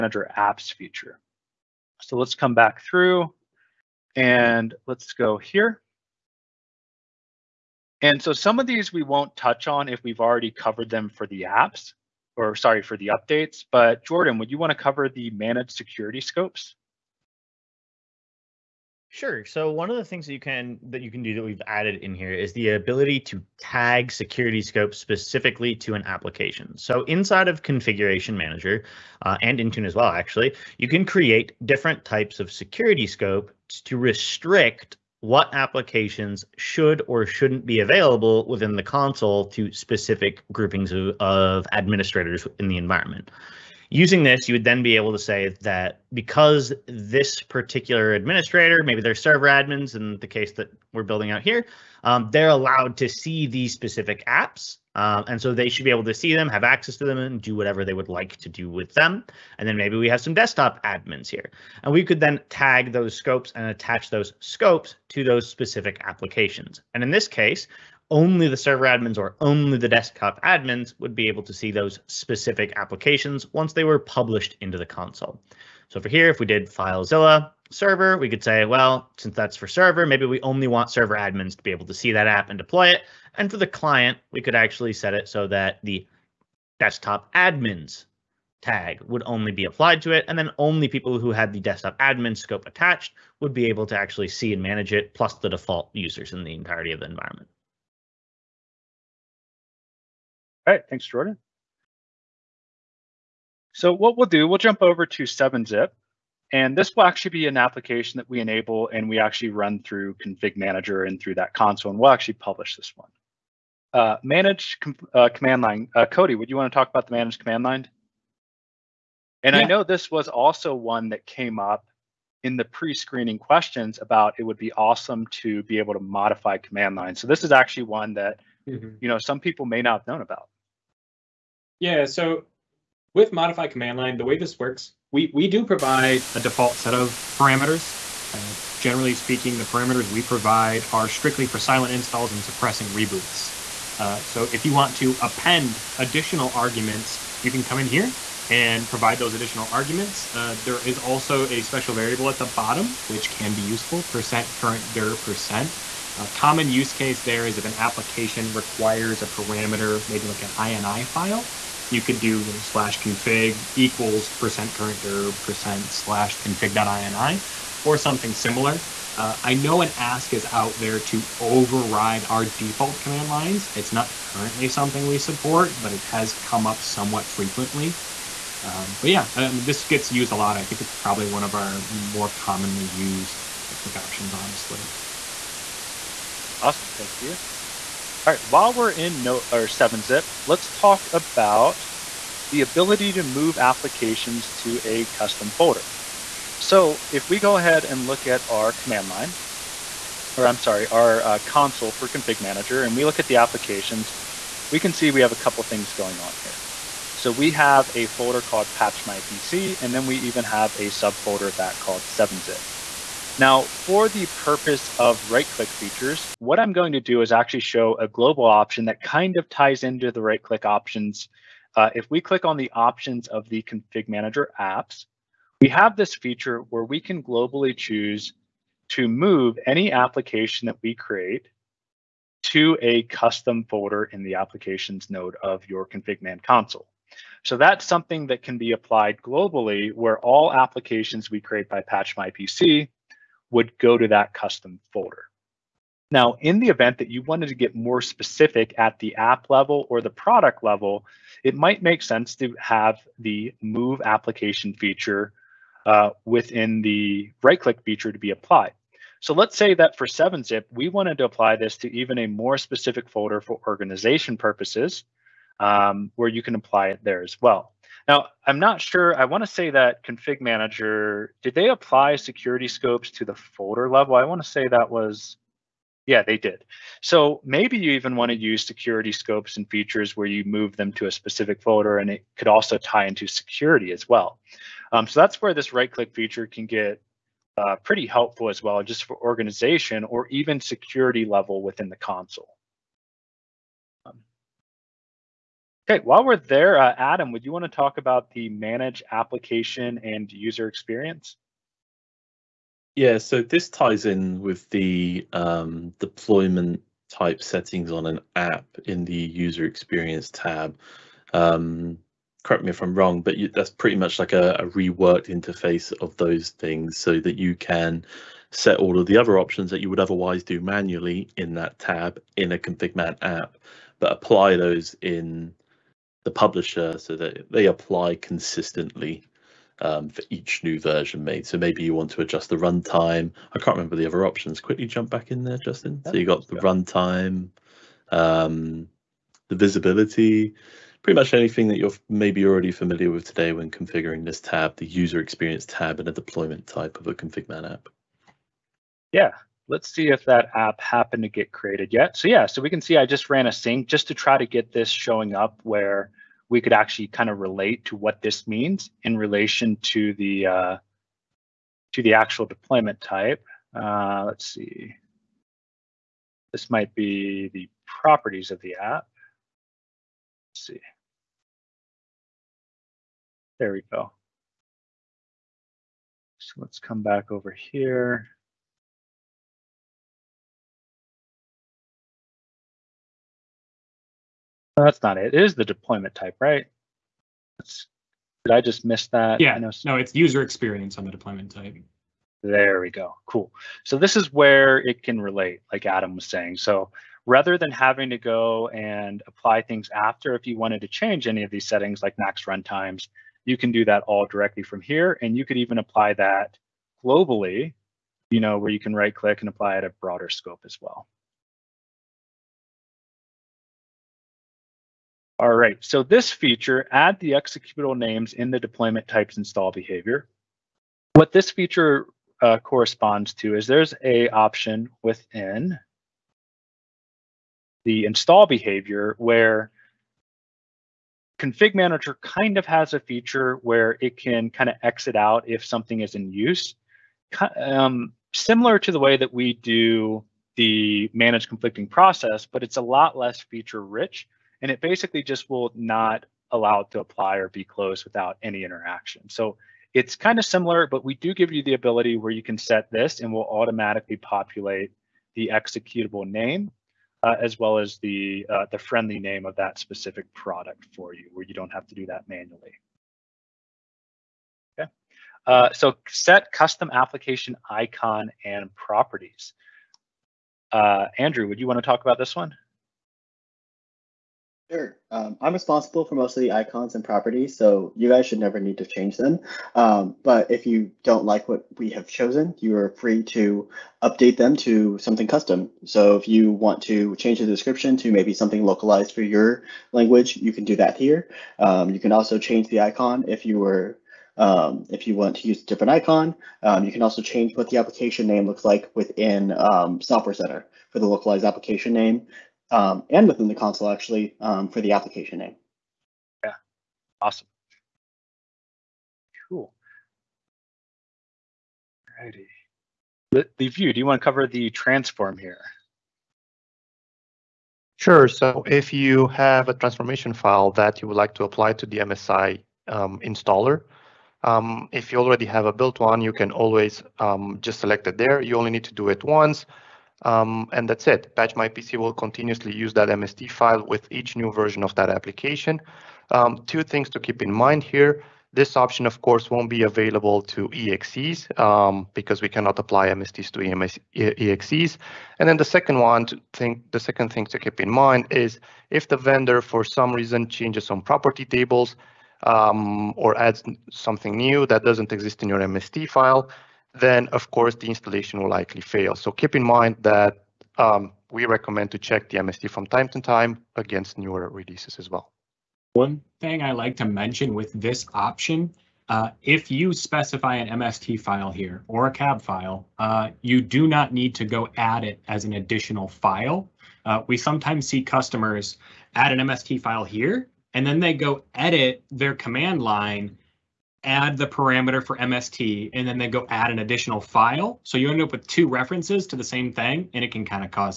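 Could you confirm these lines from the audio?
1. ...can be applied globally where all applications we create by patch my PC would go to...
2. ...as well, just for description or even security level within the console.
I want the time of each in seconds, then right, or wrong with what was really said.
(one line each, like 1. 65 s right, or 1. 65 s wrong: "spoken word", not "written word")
1. 238 s right
2. 288 s wrong: "organization", not "description".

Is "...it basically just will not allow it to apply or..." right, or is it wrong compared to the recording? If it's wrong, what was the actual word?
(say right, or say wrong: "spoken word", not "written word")
right.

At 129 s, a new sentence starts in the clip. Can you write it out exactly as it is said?
you know, some people may not have known about.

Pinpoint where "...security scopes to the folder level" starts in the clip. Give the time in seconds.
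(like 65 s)
272 s.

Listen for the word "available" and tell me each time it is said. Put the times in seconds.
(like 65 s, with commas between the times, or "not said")
37 s, 539 s.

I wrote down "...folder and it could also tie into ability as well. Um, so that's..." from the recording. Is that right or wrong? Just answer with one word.
wrong.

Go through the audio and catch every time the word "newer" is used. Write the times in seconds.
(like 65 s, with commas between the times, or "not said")
564 s.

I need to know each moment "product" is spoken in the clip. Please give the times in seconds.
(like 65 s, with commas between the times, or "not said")
250 s, 460 s.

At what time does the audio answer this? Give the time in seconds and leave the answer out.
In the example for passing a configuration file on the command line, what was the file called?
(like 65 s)
166 s.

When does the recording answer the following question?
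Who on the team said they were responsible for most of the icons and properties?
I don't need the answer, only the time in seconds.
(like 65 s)
471 s.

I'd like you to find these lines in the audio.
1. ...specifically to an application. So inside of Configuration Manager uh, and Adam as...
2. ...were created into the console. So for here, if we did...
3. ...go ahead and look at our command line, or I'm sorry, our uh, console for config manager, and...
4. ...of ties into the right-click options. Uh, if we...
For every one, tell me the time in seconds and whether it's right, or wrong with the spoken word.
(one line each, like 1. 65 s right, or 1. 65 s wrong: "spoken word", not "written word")
1. 24 s wrong: "Intune", not "Adam"
2. 73 s wrong: "published", not "created"
3. 197 s right
4. 219 s right.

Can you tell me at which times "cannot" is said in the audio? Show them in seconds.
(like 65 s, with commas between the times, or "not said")
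542 s.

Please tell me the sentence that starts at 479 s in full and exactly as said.
Um, but if you don't like what we have chosen, you are free to update them to something custom.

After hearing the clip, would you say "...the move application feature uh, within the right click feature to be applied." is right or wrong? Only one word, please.
right.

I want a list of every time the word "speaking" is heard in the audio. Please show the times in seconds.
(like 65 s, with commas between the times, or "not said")
139 s.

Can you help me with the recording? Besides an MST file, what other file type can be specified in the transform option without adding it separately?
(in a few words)
cab file.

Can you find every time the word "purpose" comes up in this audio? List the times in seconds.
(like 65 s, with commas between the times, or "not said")
214 s, 264 s.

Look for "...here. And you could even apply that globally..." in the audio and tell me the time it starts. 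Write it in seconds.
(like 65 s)
404 s.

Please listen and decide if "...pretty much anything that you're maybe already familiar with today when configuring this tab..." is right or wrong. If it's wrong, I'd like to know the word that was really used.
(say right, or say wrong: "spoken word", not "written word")
right.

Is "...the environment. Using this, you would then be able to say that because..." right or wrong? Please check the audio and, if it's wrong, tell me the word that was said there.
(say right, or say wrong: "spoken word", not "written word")
right.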